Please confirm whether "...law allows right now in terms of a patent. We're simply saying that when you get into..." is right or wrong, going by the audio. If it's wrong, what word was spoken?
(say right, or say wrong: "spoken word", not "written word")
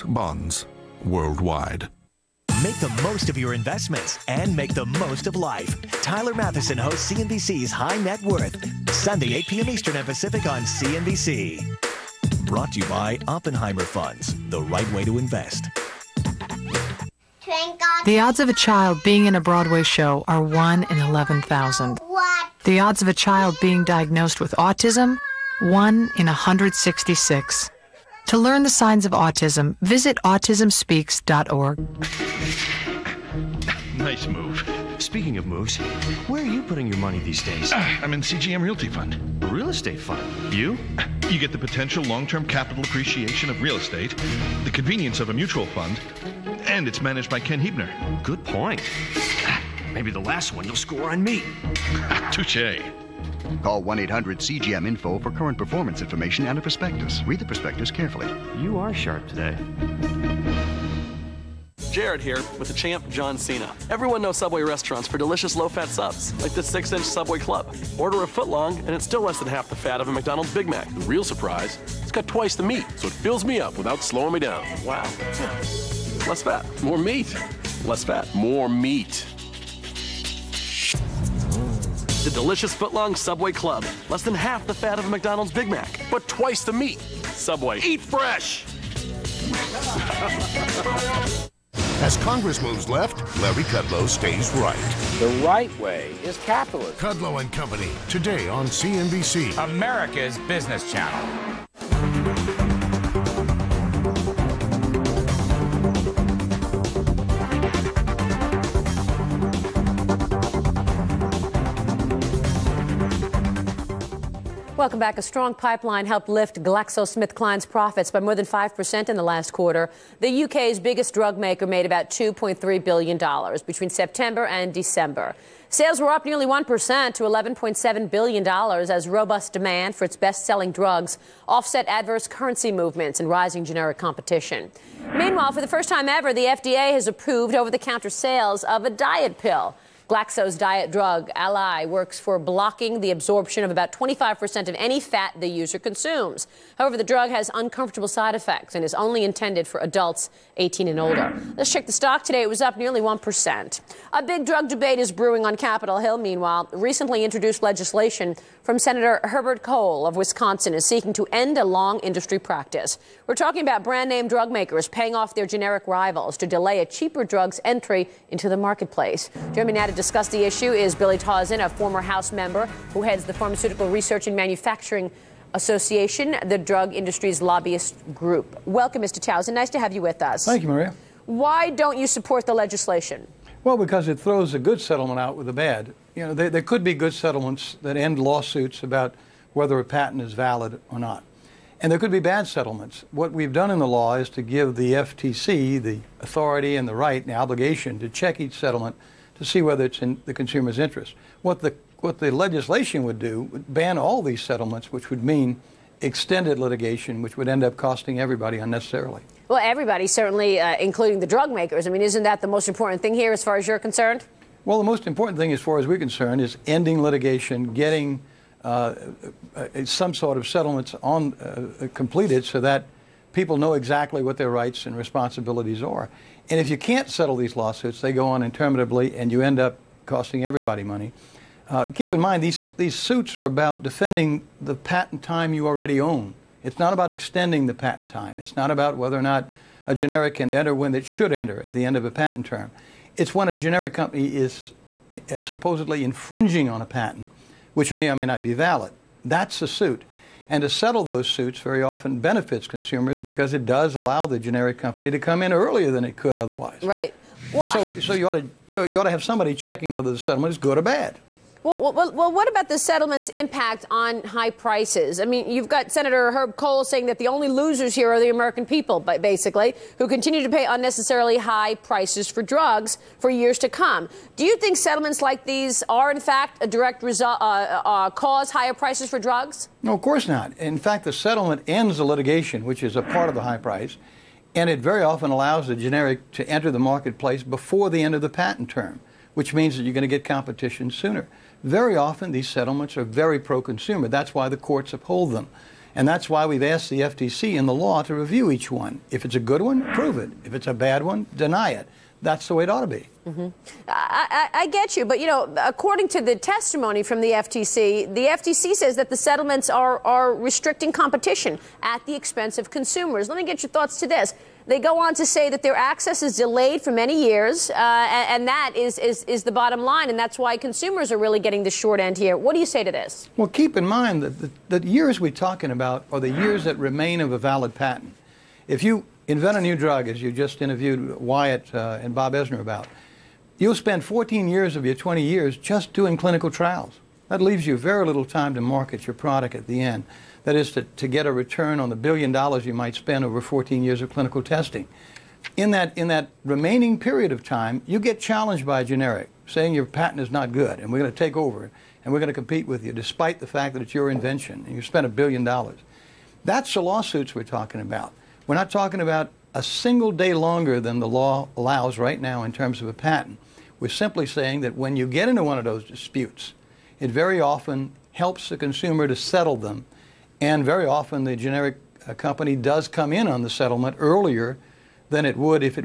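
right.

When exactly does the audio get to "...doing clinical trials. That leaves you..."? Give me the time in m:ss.
5:35.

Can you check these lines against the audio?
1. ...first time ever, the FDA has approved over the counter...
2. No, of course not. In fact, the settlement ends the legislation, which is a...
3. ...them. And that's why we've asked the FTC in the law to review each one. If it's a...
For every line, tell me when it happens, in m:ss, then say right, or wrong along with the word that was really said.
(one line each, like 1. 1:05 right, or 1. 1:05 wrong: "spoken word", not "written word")
1. 2:15 right
2. 4:39 wrong: "litigation", not "legislation"
3. 4:55 right.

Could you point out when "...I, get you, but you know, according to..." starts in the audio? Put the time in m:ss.
5:04.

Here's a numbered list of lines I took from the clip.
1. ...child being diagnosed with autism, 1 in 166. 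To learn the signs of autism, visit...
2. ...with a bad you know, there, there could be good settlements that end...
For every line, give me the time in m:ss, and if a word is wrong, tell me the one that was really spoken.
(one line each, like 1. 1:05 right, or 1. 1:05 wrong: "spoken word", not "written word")
1. 0:23 right
2. 3:05 right.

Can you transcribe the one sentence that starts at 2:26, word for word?
However, the drug has uncomfortable side effects and is only intended for adults 18 and older.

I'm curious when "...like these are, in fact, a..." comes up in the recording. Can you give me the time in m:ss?
4:35.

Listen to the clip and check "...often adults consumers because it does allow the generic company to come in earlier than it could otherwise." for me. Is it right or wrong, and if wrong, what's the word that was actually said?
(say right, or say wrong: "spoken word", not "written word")
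wrong: "benefits", not "adults".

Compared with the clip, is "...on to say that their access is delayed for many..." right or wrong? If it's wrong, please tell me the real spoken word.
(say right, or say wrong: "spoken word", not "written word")
right.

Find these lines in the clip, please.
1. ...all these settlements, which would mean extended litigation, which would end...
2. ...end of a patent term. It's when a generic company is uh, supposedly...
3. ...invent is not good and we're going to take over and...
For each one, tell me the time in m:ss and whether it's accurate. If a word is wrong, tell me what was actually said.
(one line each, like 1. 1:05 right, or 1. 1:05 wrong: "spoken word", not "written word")
1. 3:23 right
2. 4:01 right
3. 5:49 wrong: "patent", not "invent".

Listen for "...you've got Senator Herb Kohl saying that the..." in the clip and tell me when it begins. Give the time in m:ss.
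4:25.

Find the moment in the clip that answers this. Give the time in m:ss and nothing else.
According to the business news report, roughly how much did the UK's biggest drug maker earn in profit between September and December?
2:02.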